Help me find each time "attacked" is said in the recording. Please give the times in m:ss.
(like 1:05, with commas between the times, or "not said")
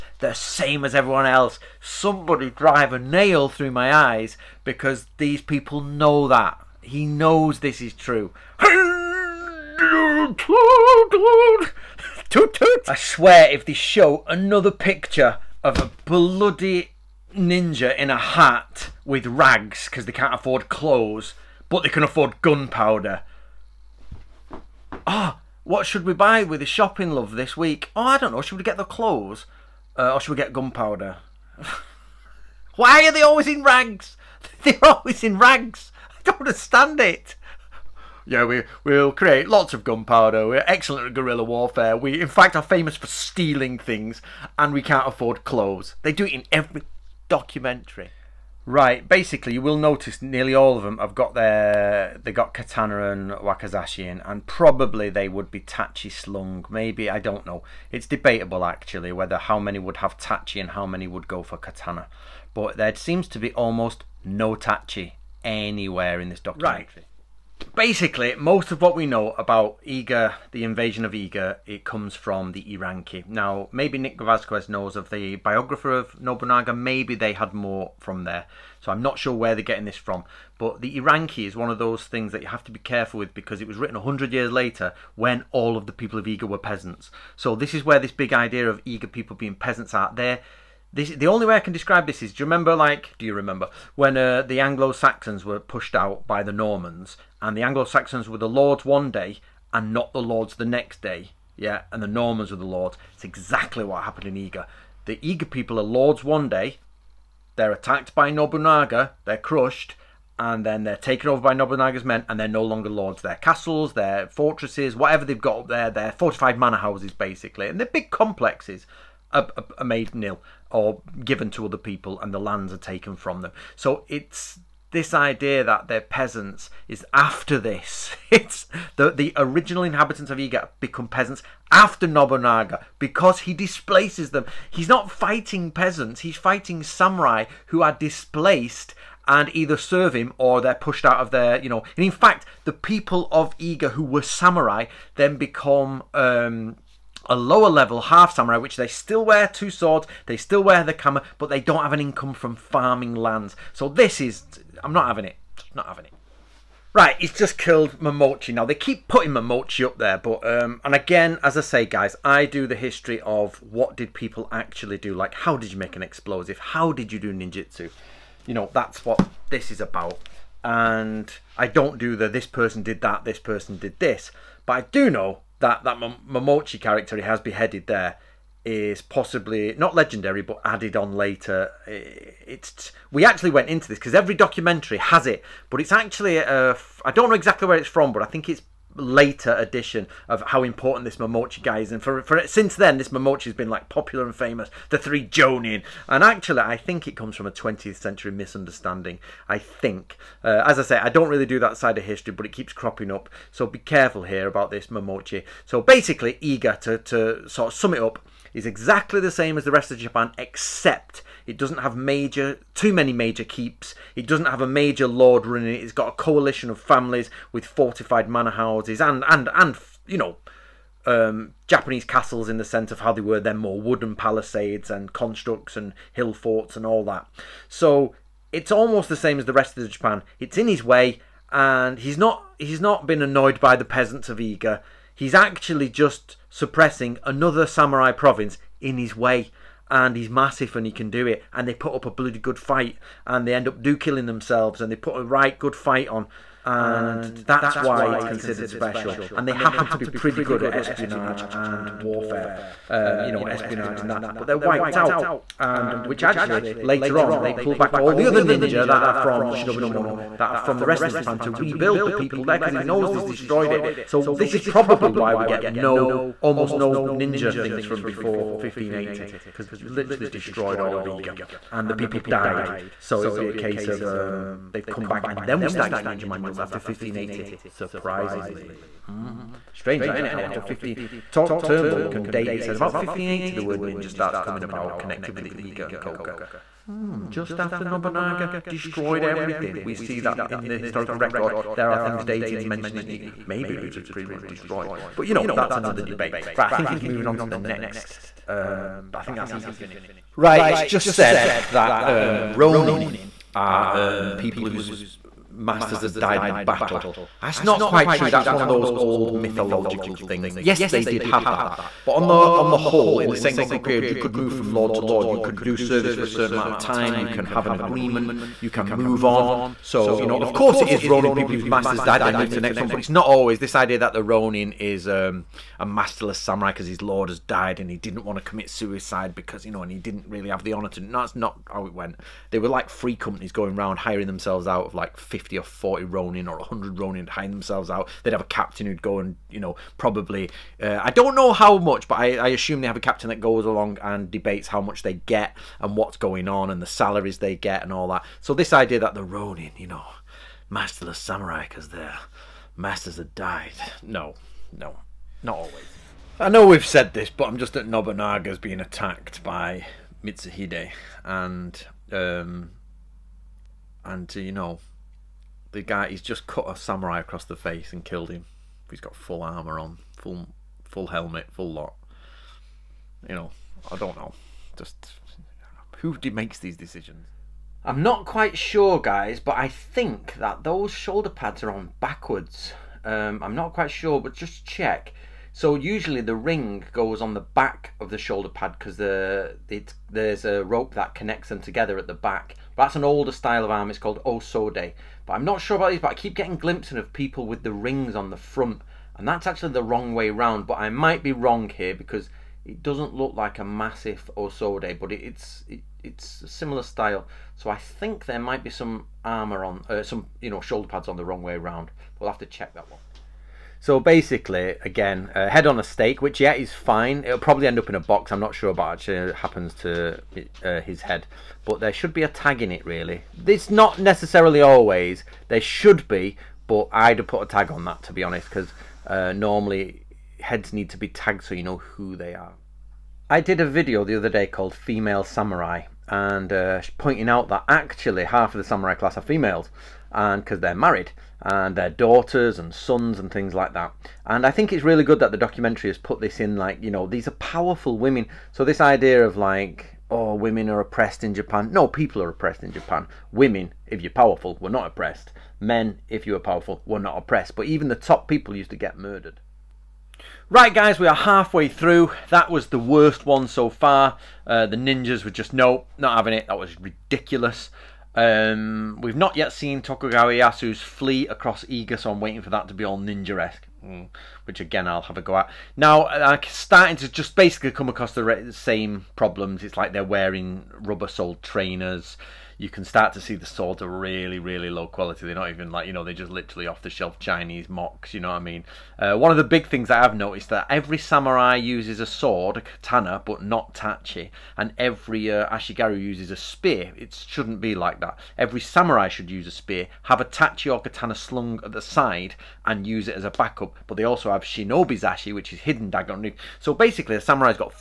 1:47, 5:58.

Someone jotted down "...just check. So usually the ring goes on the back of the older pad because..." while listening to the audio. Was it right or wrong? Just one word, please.
wrong.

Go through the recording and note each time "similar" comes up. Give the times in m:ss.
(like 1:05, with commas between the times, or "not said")
6:46.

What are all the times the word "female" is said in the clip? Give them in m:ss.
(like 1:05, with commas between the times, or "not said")
7:14, 7:19.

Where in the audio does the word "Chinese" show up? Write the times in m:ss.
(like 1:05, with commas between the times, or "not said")
8:07.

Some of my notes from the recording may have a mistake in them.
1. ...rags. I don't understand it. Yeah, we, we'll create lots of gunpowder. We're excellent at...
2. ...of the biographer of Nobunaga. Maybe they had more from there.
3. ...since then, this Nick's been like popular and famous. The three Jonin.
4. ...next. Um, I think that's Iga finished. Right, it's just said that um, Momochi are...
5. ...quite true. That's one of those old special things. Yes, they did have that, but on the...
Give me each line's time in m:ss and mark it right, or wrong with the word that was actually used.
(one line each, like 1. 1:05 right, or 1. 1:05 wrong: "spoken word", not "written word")
1. 0:35 right
2. 1:14 right
3. 3:12 wrong: "Momochi", not "Nick"
4. 4:57 wrong: "Ronin", not "Momochi"
5. 5:07 wrong: "mythological", not "special".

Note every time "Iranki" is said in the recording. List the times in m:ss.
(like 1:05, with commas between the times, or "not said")
1:12, 1:20.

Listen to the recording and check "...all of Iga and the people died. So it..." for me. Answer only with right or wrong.
right.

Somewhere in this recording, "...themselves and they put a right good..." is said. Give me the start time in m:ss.
4:04.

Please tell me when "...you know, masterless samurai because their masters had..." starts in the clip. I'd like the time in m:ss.
5:49.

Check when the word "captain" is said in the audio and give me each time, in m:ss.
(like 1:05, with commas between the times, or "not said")
5:38, 5:43.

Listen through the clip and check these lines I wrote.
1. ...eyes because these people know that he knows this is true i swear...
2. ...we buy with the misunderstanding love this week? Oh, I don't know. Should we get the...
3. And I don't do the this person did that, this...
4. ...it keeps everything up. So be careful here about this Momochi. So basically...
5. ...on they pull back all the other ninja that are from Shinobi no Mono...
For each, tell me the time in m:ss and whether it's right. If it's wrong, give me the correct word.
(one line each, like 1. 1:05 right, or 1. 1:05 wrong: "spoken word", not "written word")
1. 0:03 right
2. 0:26 wrong: "shopping", not "misunderstanding"
3. 2:50 right
4. 3:22 wrong: "cropping", not "everything"
5. 4:17 right.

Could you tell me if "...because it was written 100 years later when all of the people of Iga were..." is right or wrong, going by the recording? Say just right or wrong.
right.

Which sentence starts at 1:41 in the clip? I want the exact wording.
Yeah, and the Normans were the lords.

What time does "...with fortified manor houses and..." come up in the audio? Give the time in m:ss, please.
3:37.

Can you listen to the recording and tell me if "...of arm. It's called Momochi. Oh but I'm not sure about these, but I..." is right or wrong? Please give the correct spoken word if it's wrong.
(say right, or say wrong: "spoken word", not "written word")
wrong: "Osode", not "Momochi".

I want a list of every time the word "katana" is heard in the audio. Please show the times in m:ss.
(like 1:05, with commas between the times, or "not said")
0:52, 1:01, 8:12, 8:20.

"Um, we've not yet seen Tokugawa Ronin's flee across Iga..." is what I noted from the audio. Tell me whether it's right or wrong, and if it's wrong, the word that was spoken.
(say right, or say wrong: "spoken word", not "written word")
wrong: "Ieyasu", not "Ronin".